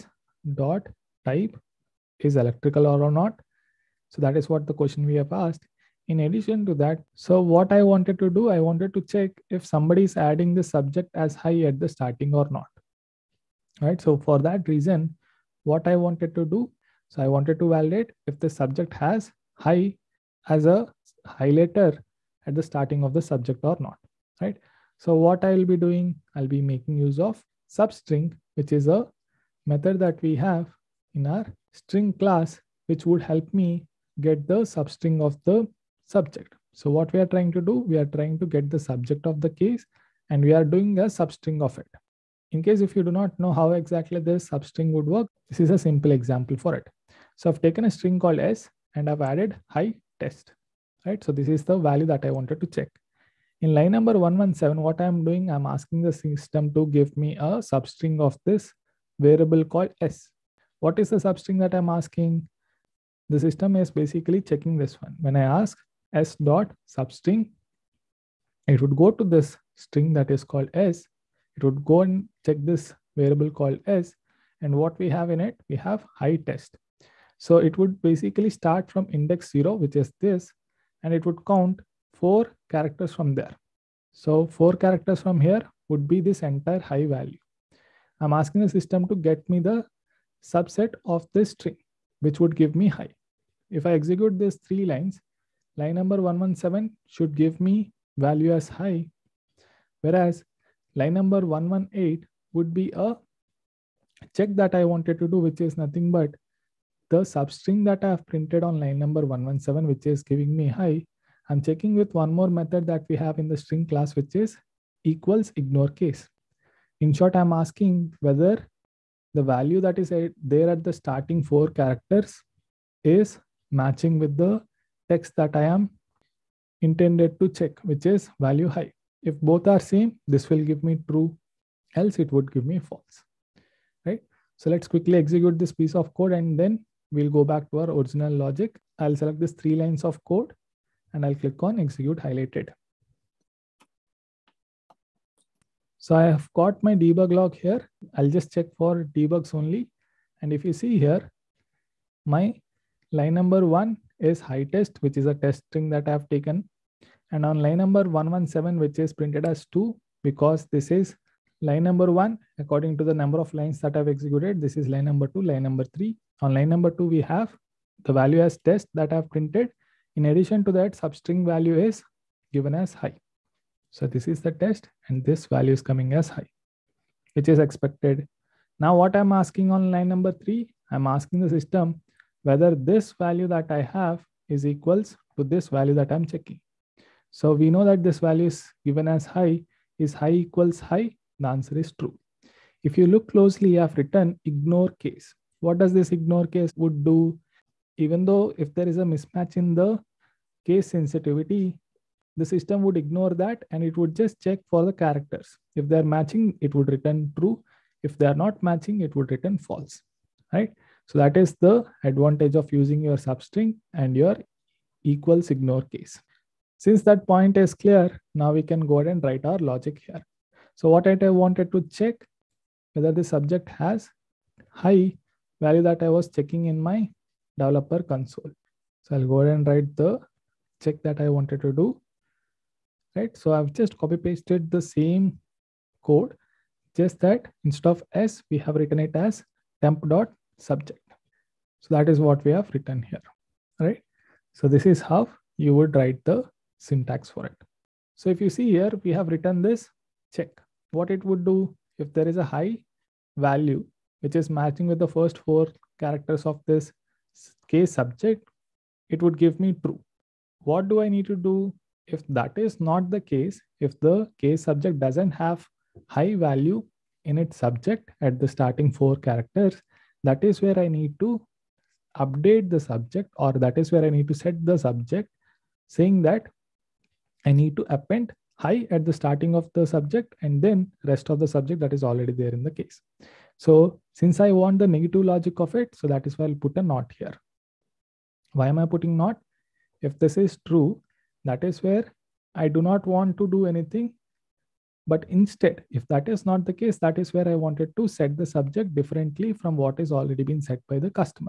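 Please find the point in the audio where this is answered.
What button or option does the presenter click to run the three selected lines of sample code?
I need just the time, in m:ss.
2:21.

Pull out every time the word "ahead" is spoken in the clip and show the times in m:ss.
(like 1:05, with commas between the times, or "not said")
3:38, 3:49.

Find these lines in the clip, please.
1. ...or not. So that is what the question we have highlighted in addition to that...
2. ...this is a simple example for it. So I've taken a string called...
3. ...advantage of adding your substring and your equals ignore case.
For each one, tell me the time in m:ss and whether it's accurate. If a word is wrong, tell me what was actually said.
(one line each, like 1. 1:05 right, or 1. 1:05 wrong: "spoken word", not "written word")
1. 0:02 wrong: "asked", not "highlighted"
2. 0:45 right
3. 3:32 wrong: "using", not "adding".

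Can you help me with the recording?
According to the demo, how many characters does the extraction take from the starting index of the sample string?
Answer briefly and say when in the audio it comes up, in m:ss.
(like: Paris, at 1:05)
4, at 1:21.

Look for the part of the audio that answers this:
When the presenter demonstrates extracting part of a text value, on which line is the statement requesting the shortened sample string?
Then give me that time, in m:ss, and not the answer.
0:53.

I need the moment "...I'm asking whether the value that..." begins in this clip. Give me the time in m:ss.
1:57.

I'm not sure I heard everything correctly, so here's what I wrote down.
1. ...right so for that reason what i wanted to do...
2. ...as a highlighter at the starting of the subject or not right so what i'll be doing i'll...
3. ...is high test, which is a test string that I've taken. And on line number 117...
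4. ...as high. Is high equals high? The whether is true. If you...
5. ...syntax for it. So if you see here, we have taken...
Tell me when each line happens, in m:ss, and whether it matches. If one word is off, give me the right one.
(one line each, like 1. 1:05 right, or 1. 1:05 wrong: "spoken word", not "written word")
1. 0:13 right
2. 0:20 right
3. 2:34 right
4. 3:09 wrong: "answer", not "whether"
5. 4:06 wrong: "written", not "taken".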